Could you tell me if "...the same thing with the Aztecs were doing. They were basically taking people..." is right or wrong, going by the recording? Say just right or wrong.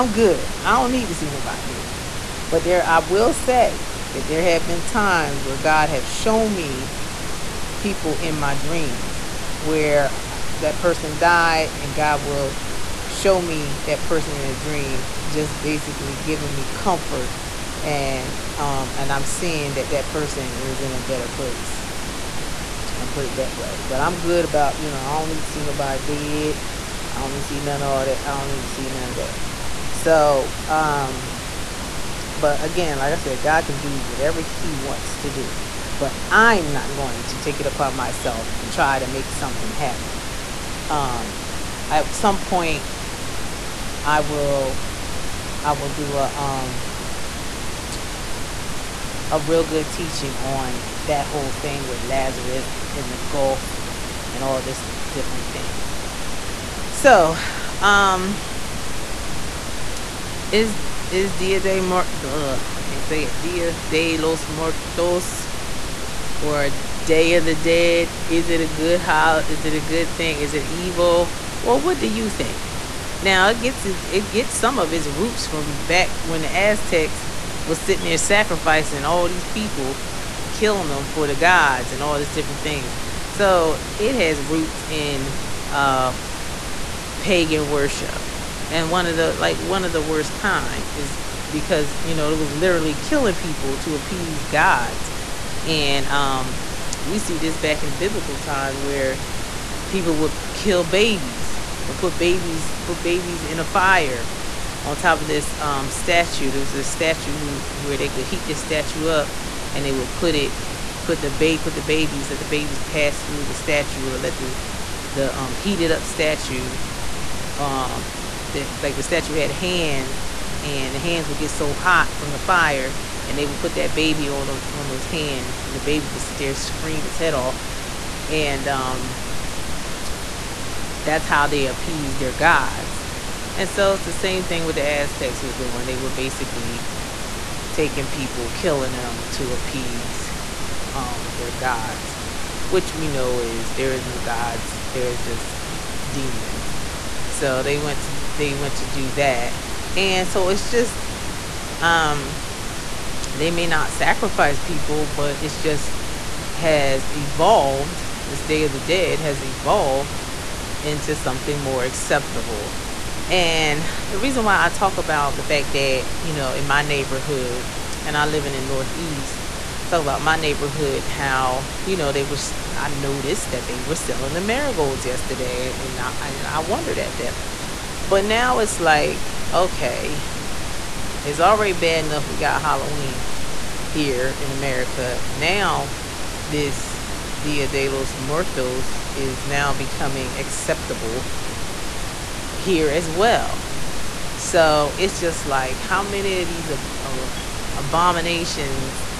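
right.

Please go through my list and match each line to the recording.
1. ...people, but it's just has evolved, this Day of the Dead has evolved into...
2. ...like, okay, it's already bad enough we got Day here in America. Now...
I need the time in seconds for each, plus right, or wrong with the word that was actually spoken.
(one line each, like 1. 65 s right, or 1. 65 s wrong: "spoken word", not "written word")
1. 154 s right
2. 178 s wrong: "Halloween", not "Day".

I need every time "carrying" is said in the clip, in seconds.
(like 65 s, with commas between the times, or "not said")
not said.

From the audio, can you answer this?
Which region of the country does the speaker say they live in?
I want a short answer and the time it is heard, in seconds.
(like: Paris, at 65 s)
The Northeast, at 168 s.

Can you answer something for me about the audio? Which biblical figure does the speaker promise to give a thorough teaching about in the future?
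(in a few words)
Lazarus.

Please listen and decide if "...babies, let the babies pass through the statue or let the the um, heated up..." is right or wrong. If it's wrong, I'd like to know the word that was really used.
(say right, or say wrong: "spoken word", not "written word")
right.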